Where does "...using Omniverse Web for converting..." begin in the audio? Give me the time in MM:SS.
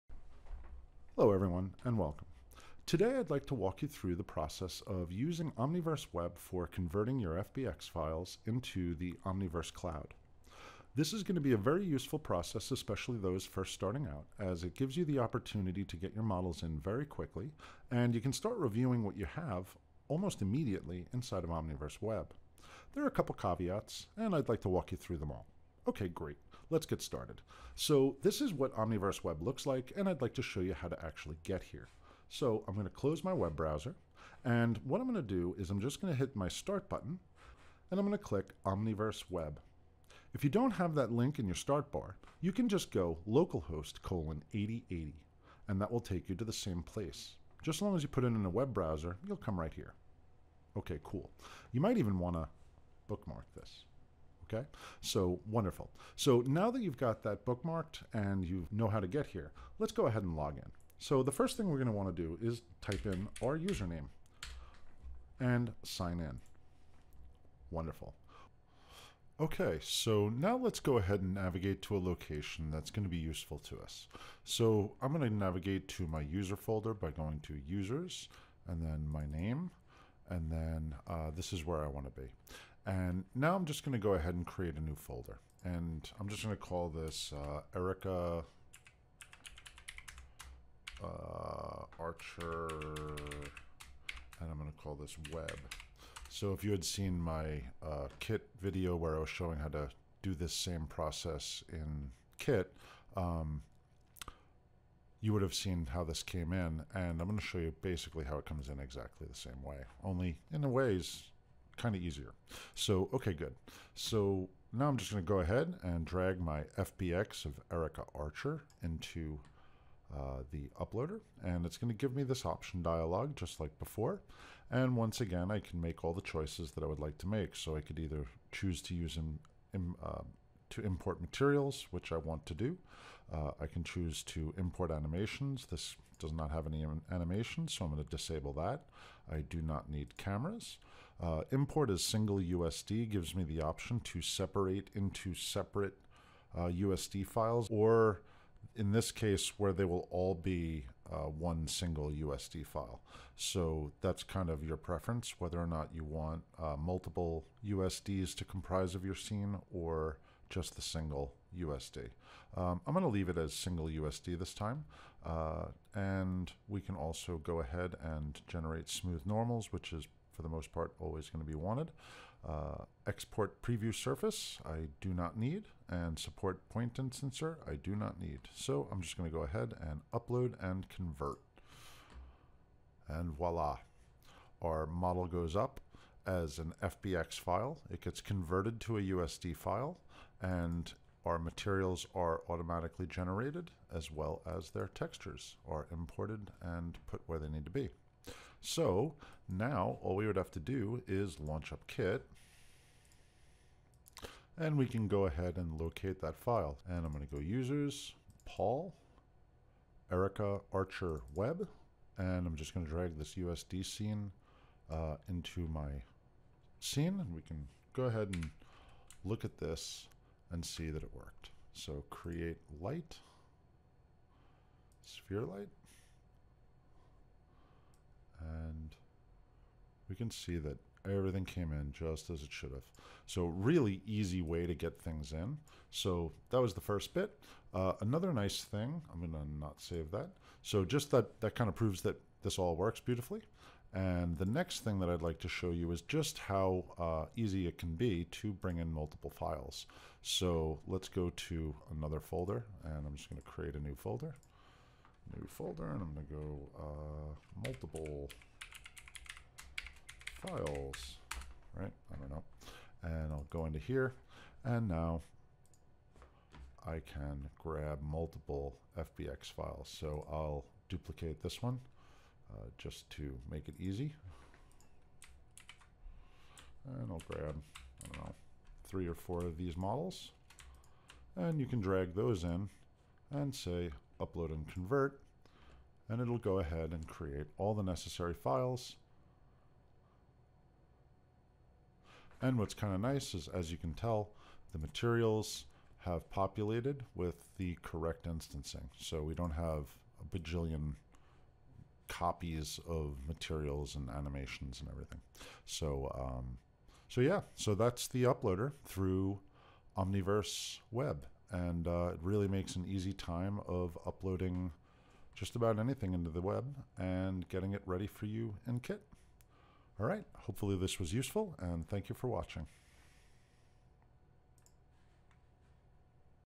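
00:05.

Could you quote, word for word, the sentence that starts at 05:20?
All right, hopefully this was useful, and thank you for watching.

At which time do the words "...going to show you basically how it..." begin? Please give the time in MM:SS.
01:47.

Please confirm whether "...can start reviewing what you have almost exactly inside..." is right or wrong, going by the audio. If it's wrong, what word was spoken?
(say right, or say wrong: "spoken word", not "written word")
wrong: "immediately", not "exactly".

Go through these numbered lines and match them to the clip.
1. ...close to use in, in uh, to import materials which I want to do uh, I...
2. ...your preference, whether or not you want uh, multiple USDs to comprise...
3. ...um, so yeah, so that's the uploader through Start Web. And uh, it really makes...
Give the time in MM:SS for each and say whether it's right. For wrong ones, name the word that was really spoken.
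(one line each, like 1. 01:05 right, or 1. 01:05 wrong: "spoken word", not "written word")
1. 02:08 wrong: "choose", not "close"
2. 02:34 right
3. 05:06 wrong: "Omniverse", not "Start".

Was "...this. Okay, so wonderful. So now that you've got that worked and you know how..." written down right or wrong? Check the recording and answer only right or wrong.
wrong.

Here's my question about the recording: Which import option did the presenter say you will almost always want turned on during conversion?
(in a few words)
generate smooth normals.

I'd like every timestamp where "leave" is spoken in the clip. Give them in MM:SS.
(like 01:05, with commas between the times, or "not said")
02:43.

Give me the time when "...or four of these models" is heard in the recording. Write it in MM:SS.
04:39.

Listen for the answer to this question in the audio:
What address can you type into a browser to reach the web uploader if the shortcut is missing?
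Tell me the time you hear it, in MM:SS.
00:43.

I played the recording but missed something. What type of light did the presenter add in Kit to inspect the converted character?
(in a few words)
sphere light.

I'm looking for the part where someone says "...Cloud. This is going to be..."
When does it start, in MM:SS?
00:09.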